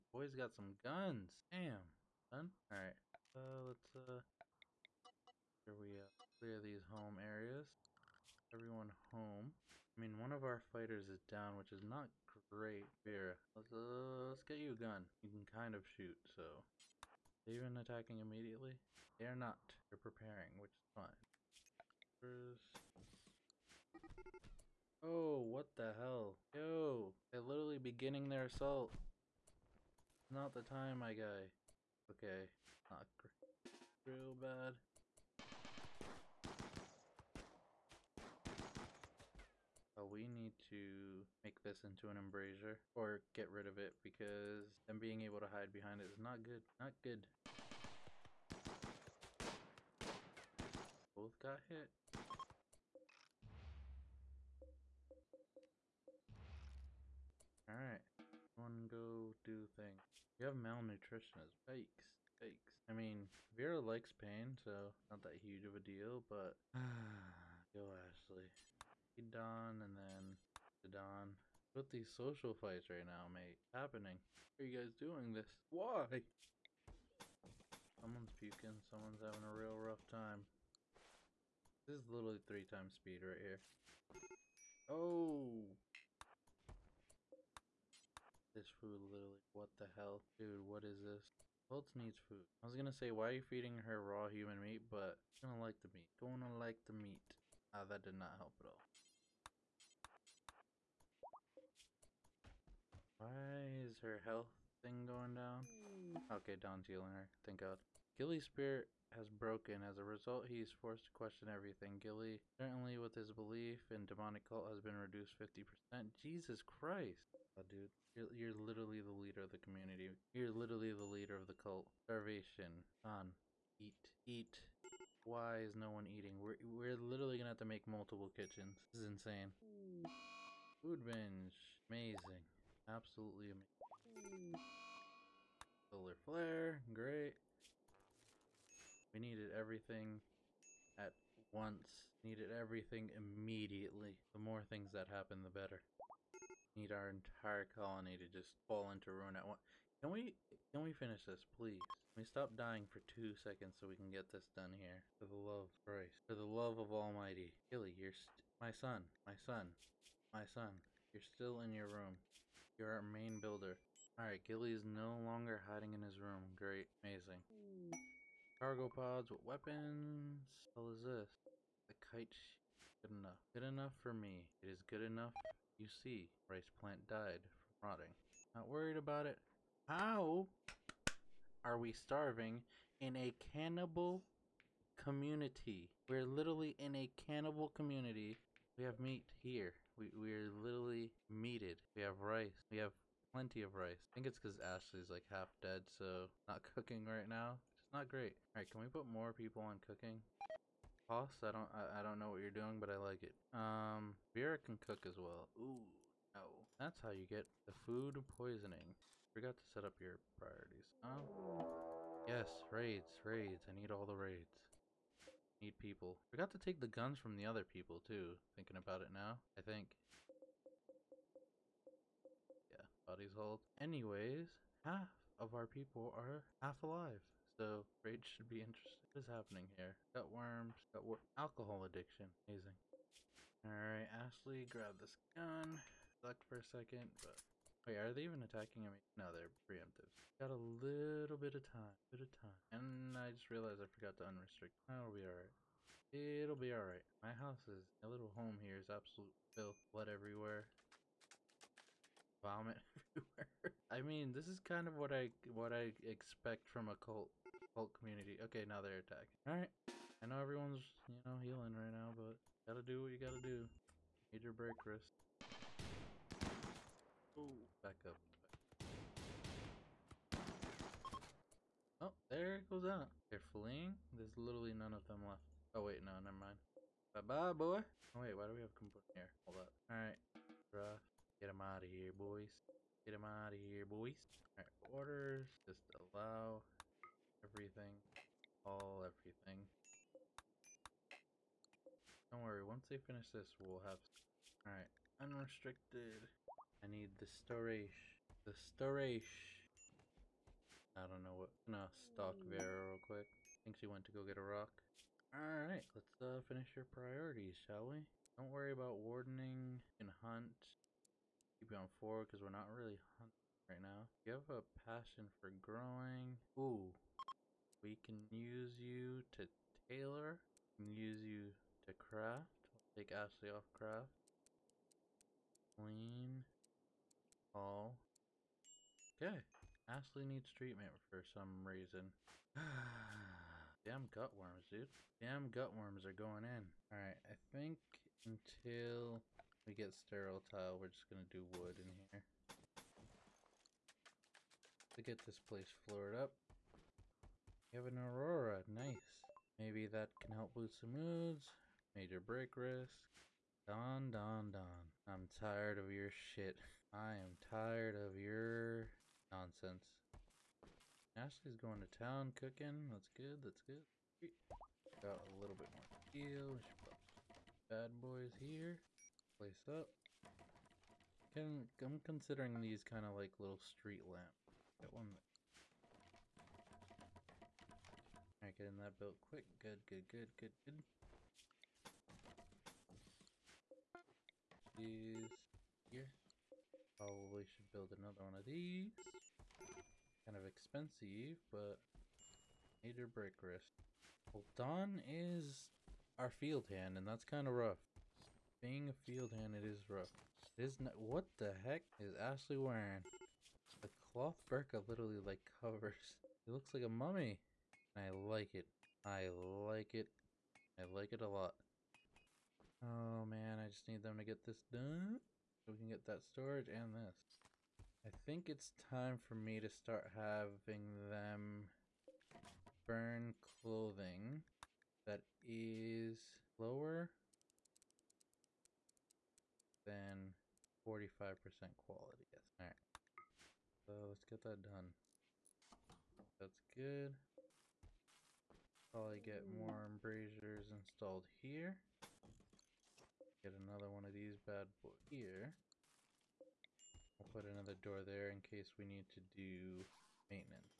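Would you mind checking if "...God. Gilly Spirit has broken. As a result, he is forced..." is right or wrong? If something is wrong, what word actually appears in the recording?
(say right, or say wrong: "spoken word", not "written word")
right.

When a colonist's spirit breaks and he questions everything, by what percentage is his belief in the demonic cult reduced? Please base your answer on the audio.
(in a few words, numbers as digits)
50%.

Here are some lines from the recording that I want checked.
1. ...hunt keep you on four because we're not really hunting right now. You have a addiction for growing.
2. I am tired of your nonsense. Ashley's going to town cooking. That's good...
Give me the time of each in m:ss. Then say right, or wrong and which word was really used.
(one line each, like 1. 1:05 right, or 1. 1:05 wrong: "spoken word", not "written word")
1. 5:10 wrong: "passion", not "addiction"
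2. 5:56 right.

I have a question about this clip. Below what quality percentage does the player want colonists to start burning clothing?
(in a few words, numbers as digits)
45%.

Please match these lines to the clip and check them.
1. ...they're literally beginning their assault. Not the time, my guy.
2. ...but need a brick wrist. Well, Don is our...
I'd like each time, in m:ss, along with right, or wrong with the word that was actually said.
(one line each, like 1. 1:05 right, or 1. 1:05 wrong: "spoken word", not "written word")
1. 0:27 right
2. 6:31 right.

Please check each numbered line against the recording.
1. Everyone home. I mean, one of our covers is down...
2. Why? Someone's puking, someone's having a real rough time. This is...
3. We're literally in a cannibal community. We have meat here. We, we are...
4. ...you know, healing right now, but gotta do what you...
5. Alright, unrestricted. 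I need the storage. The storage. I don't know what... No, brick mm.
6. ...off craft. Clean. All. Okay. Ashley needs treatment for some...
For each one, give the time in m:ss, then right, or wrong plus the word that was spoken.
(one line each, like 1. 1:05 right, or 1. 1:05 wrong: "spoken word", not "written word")
1. 0:08 wrong: "fighters", not "covers"
2. 1:15 right
3. 3:06 right
4. 4:21 right
5. 4:54 wrong: "stock", not "brick"
6. 5:23 right.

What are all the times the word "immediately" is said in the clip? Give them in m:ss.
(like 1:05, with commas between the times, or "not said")
0:18, 2:23.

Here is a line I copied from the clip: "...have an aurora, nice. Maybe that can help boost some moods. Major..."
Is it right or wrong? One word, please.
right.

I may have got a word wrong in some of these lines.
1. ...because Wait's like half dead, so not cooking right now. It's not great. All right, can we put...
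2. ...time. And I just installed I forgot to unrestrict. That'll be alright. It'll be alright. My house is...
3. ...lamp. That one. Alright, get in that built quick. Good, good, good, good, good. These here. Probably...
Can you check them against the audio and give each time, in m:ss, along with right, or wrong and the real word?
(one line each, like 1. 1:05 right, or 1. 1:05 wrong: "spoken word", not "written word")
1. 3:14 wrong: "Ashley", not "Wait"
2. 4:02 wrong: "realized", not "installed"
3. 6:14 right.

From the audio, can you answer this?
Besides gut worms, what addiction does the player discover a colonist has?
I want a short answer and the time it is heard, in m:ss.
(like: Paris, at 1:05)
Alcohol addiction, at 3:51.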